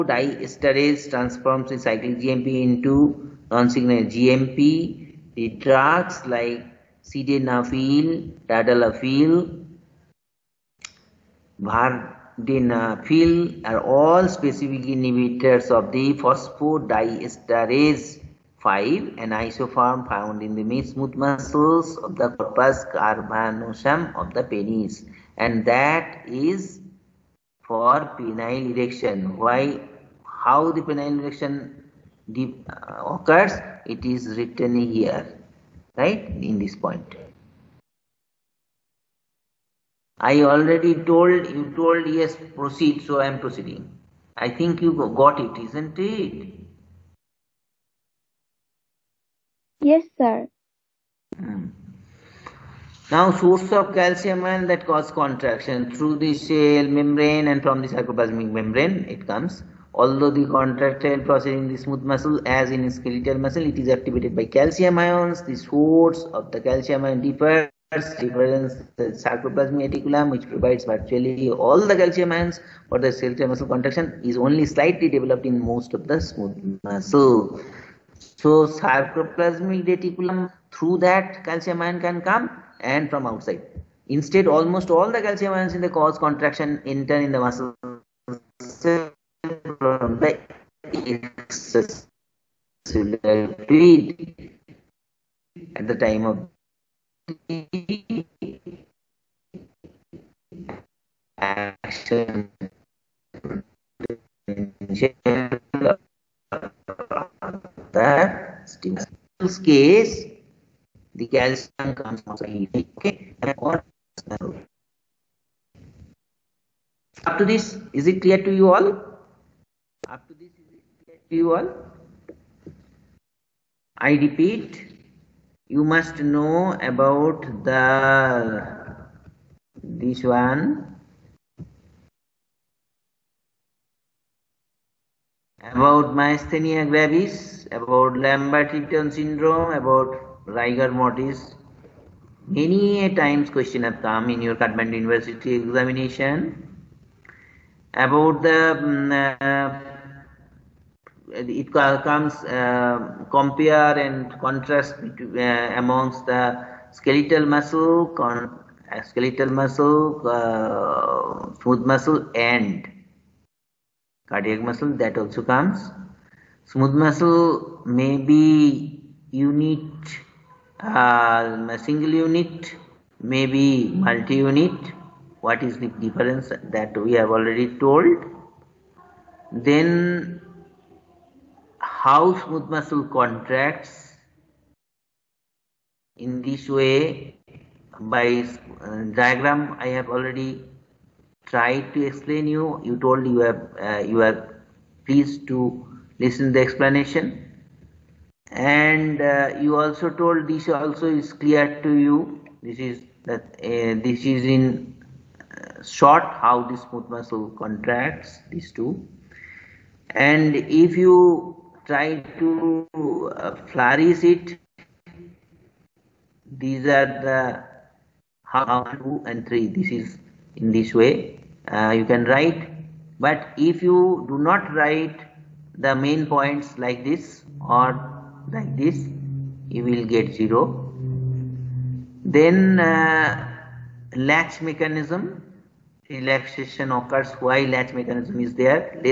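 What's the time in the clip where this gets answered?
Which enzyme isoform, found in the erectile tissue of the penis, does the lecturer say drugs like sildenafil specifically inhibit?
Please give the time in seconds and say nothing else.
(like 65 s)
16 s.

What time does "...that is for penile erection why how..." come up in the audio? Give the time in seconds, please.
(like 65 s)
25 s.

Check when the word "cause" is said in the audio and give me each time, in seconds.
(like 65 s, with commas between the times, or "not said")
54 s, 85 s.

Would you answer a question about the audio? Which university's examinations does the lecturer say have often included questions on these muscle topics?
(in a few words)
Kathmandu University.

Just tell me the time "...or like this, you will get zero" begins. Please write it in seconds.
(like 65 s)
227 s.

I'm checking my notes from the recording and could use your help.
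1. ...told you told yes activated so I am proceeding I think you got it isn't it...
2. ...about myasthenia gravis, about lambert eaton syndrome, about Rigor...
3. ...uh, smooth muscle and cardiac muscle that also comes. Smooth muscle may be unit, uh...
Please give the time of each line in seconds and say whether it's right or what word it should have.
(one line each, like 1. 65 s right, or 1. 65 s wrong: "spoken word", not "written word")
1. 40 s wrong: "proceed", not "activated"
2. 135 s right
3. 160 s right.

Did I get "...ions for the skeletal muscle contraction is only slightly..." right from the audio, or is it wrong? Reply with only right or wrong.
right.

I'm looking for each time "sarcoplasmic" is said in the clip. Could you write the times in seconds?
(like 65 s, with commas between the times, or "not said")
57 s, 69 s, 78 s.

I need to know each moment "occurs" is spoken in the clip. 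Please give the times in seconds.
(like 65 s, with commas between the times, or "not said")
33 s, 236 s.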